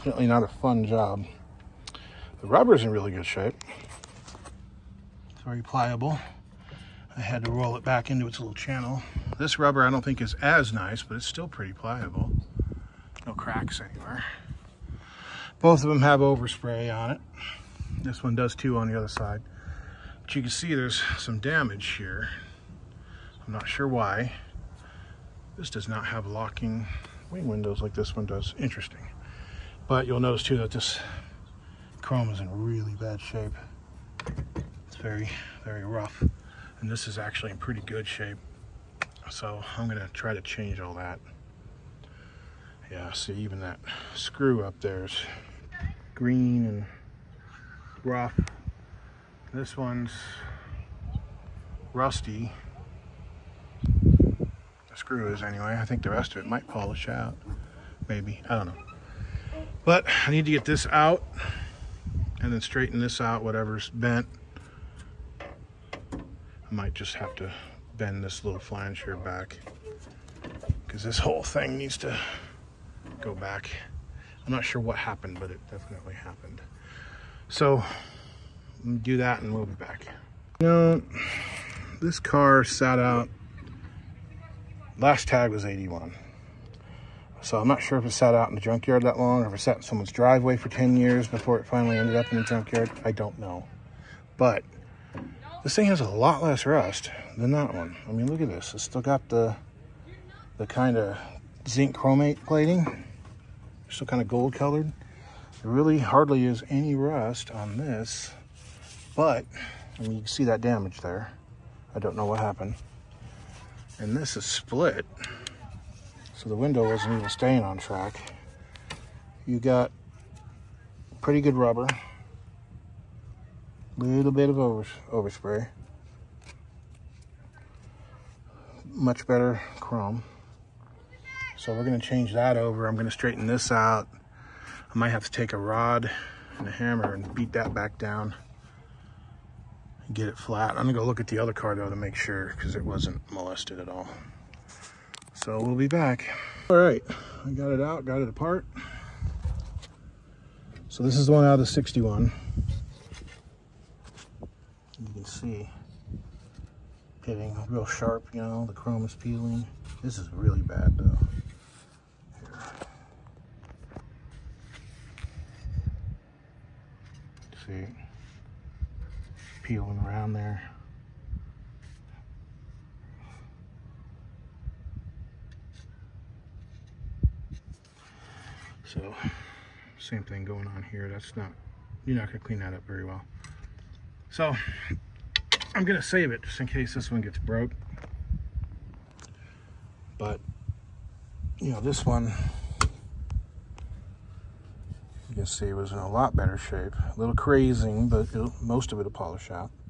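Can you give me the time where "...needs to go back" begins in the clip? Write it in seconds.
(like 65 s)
71 s.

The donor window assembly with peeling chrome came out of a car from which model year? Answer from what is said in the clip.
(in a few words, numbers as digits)
1961.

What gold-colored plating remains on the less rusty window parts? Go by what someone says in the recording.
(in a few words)
zinc chromate.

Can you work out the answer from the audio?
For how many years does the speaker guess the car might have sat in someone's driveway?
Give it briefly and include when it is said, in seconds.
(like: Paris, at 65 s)
10, at 90 s.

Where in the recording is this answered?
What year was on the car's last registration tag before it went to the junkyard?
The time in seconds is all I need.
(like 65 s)
85 s.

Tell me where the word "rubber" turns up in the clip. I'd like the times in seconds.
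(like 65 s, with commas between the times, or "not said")
2 s, 9 s, 121 s.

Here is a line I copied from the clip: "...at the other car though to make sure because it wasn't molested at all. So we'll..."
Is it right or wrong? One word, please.
right.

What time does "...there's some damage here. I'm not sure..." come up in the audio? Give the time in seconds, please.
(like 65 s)
20 s.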